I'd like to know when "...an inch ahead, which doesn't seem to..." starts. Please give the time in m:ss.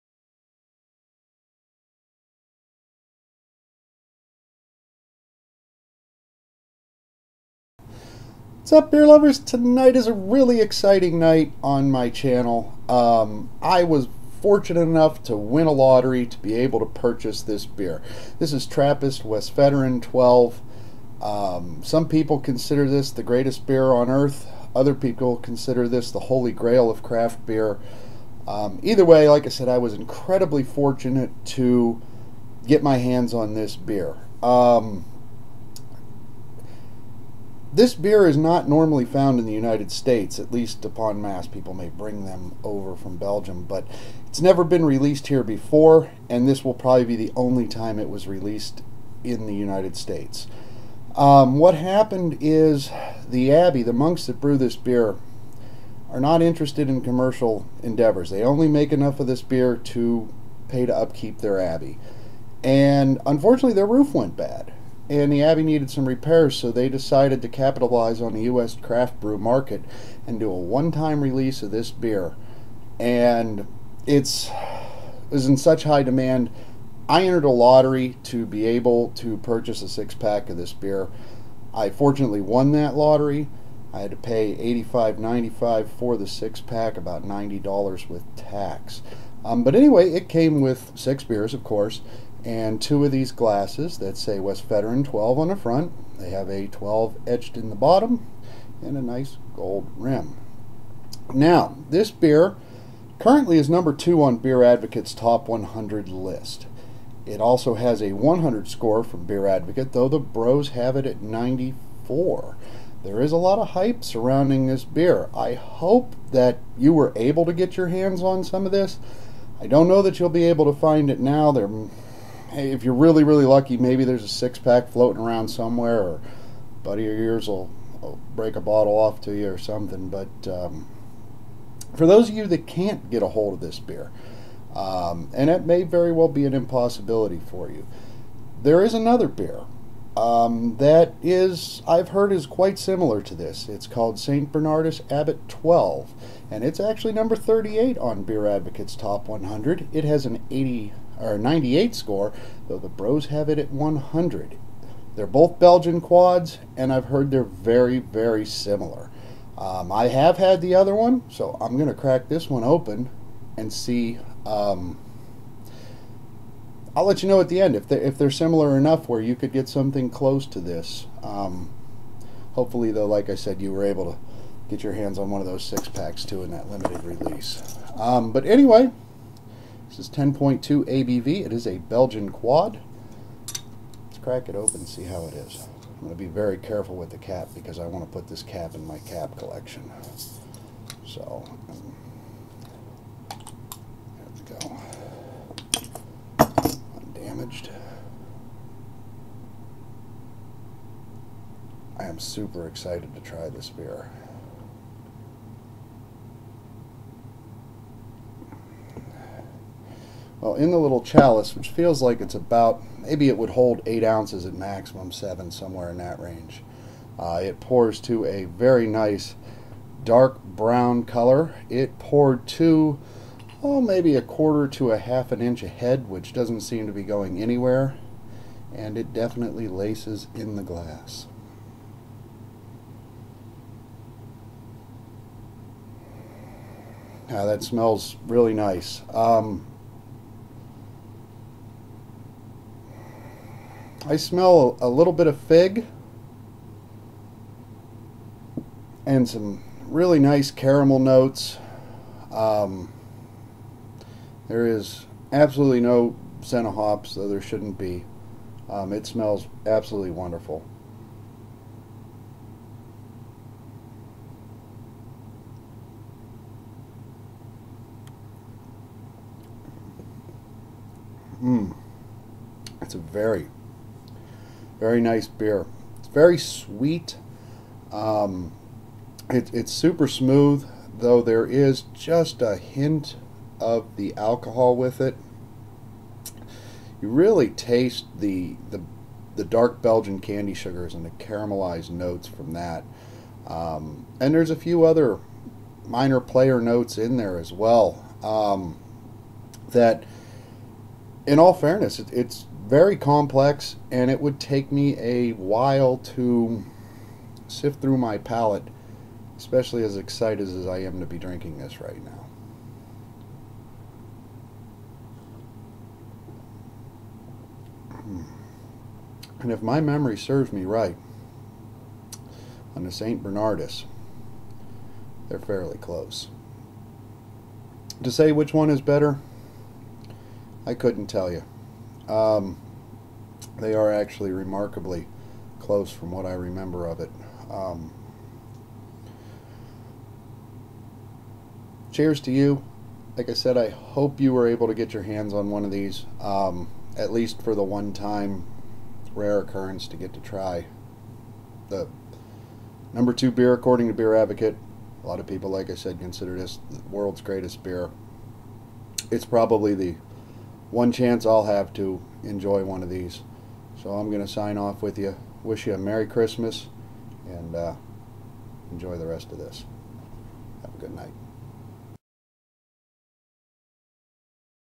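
3:45.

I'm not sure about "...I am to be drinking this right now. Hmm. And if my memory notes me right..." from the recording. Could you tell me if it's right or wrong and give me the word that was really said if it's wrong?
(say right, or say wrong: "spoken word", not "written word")
wrong: "serves", not "notes".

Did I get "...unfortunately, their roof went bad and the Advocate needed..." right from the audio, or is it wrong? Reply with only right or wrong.
wrong.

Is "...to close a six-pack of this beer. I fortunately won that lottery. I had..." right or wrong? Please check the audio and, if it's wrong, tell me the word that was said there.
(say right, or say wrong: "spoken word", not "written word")
wrong: "purchase", not "close".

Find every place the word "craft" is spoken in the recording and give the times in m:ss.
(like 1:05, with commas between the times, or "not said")
0:27, 1:08.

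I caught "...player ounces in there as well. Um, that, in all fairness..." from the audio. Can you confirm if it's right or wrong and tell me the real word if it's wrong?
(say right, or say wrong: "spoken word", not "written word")
wrong: "notes", not "ounces".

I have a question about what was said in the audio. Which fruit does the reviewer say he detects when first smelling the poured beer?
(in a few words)
Fig.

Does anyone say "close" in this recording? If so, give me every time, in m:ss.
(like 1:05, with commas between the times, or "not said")
2:50, 5:25, 5:35.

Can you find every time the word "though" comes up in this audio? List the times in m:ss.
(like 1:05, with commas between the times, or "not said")
1:49, 2:32, 2:52, 4:17, 4:40.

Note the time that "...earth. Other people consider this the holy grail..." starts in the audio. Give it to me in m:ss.
0:24.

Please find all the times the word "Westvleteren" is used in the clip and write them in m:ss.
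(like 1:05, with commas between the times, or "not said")
0:19, 1:34.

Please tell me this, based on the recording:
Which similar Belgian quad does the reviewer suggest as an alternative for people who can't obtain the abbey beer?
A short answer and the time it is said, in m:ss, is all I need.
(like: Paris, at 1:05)
Saint Bernardus Abbott 12, at 2:24.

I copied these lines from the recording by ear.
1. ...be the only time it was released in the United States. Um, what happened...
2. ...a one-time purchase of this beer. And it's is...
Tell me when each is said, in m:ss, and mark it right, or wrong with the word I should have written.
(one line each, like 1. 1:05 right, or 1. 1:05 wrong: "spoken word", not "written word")
1. 0:47 right
2. 1:10 wrong: "release", not "purchase".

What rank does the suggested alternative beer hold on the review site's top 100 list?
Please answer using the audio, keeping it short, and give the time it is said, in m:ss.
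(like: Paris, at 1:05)
38, at 2:27.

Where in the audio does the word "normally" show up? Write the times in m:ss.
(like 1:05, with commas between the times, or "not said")
0:38.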